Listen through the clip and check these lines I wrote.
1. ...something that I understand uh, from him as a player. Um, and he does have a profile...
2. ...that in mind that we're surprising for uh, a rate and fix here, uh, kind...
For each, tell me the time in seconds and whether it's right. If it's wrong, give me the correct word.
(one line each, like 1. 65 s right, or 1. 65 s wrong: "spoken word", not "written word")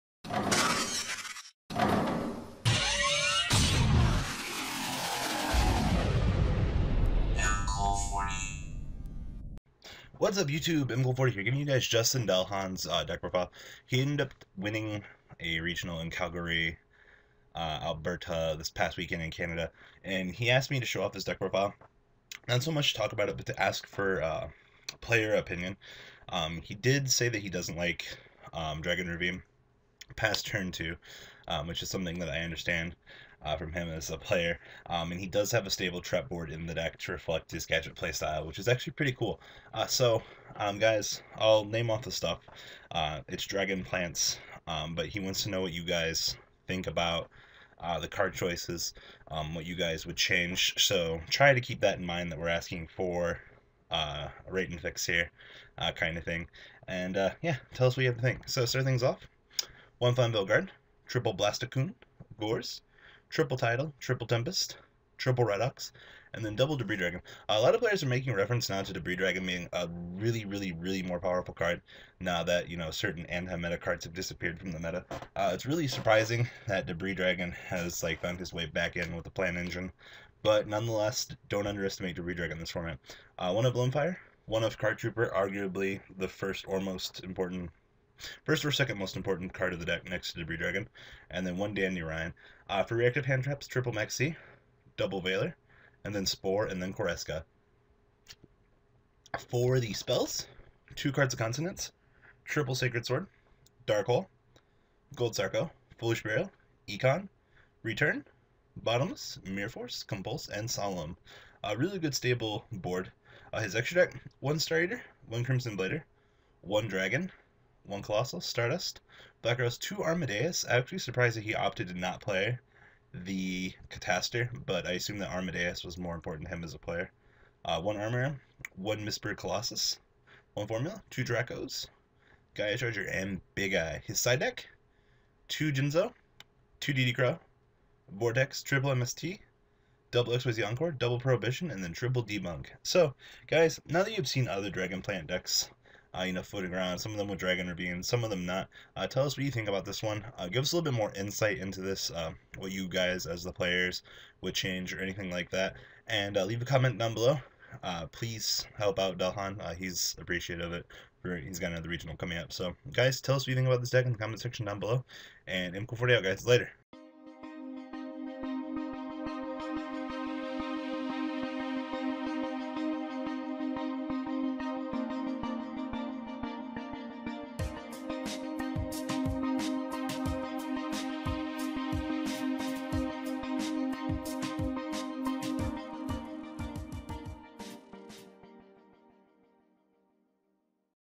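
1. 31 s wrong: "stable", not "profile"
2. 51 s wrong: "asking", not "surprising".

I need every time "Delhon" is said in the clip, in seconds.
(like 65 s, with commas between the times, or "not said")
12 s, 159 s.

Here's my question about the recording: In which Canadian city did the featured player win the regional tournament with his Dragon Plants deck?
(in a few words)
Calgary.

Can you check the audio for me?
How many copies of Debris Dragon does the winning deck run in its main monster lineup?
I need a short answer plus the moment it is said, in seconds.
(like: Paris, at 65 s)
2, at 66 s.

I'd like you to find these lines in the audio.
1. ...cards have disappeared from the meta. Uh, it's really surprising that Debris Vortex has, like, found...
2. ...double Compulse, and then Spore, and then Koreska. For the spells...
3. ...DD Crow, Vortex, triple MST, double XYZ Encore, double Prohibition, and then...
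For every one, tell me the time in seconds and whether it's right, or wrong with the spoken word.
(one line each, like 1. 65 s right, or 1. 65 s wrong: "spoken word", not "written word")
1. 73 s wrong: "Dragon", not "Vortex"
2. 94 s wrong: "Veiler", not "Compulse"
3. 136 s right.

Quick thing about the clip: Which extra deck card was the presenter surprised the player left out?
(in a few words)
Catastor.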